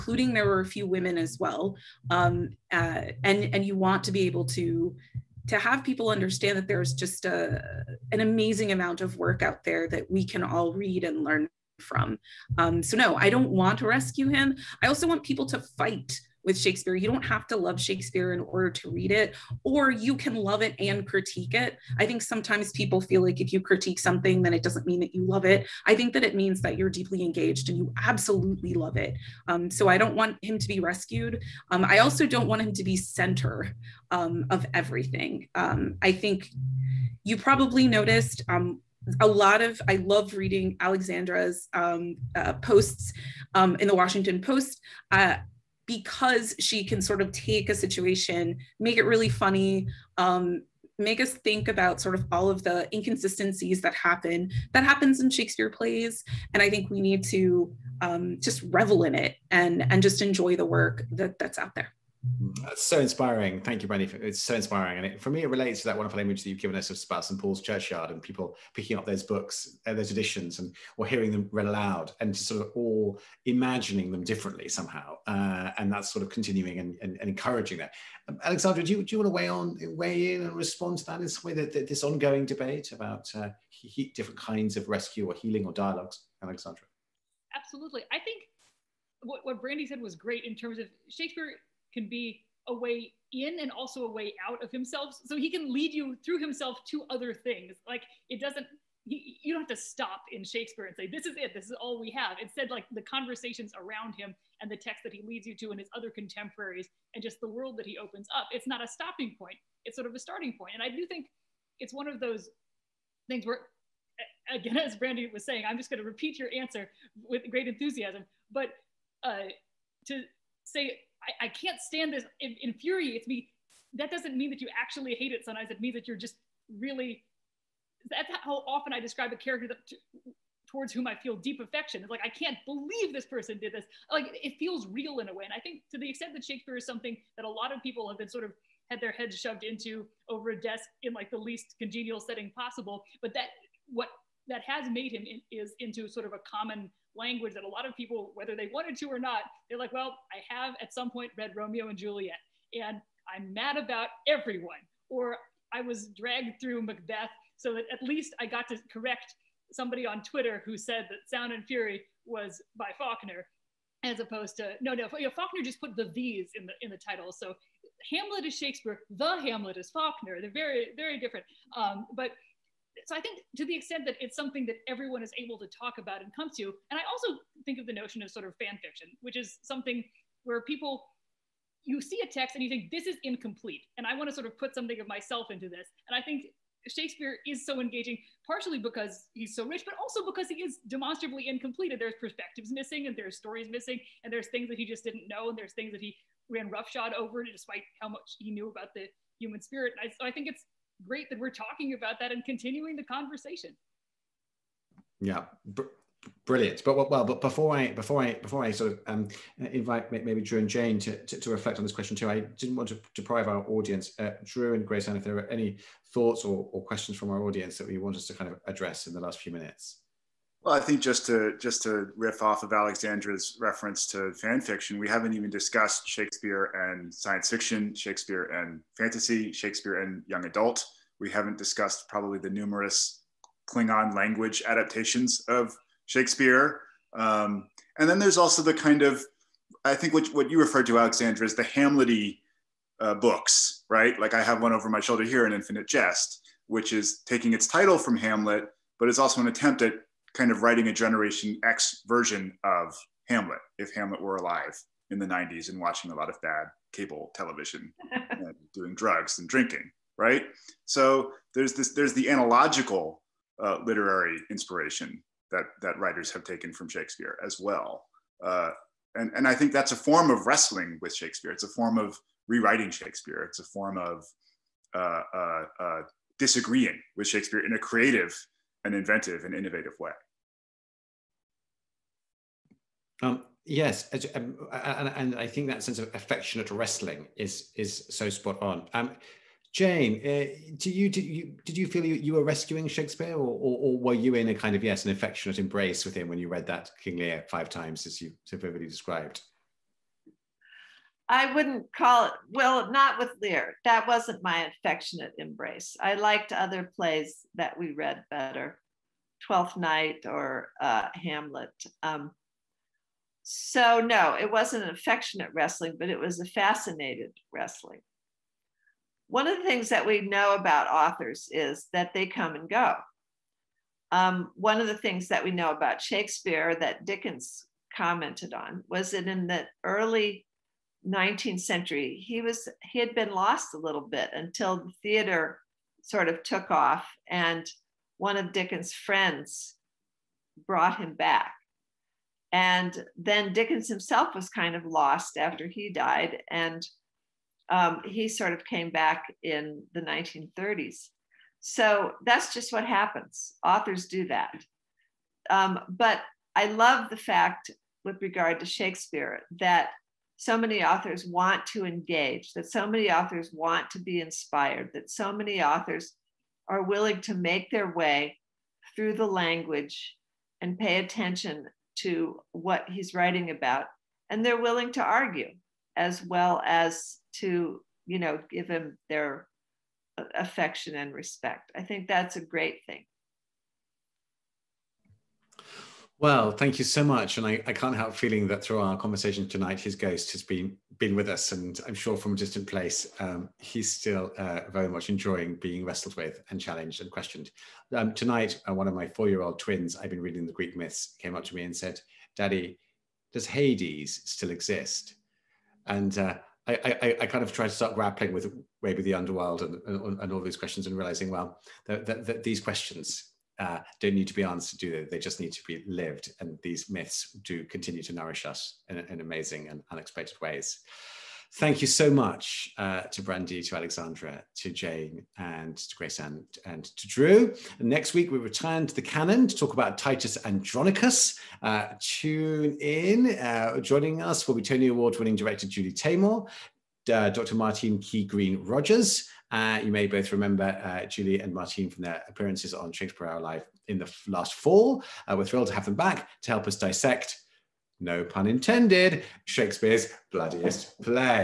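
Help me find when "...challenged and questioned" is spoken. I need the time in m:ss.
6:36.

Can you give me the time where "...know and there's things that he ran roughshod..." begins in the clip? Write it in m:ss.
3:15.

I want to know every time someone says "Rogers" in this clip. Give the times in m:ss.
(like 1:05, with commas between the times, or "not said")
7:18.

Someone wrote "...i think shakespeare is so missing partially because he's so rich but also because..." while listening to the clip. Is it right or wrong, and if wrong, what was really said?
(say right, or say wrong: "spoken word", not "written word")
wrong: "engaging", not "missing".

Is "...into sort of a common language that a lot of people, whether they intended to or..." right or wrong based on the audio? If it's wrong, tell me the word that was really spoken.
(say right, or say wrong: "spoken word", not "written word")
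wrong: "wanted", not "intended".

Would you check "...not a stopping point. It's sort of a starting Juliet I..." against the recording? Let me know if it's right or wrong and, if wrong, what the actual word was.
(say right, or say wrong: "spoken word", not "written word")
wrong: "And", not "Juliet".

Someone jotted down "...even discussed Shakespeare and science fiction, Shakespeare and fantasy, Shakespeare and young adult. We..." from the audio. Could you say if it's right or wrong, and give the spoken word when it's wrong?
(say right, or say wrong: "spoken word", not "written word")
right.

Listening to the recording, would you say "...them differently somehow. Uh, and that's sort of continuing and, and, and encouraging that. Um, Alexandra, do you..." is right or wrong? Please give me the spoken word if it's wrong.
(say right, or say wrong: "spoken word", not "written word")
right.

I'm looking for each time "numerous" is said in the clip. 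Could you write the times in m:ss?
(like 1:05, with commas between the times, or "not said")
3:52.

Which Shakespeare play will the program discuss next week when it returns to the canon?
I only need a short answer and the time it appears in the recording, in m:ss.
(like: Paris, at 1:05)
Titus Andronicus, at 7:09.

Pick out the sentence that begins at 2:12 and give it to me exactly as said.
It's like, I can't believe this person did this.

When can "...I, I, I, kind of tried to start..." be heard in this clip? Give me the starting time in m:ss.
6:46.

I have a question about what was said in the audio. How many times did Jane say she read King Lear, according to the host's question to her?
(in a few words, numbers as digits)
5.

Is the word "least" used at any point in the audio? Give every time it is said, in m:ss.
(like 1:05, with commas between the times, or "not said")
2:21, 2:38.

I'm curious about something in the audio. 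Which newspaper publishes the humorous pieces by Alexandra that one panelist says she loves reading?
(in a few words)
The Washington Post.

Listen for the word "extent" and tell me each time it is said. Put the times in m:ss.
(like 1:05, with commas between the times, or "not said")
2:16, 2:53.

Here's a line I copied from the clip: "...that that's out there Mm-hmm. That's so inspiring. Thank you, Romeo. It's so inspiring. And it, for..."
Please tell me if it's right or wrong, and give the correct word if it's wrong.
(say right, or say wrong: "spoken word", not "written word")
wrong: "Brandi", not "Romeo".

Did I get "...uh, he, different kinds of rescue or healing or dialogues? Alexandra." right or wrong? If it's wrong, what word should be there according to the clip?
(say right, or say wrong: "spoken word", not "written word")
right.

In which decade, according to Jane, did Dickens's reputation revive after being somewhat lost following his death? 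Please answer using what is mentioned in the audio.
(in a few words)
1930s.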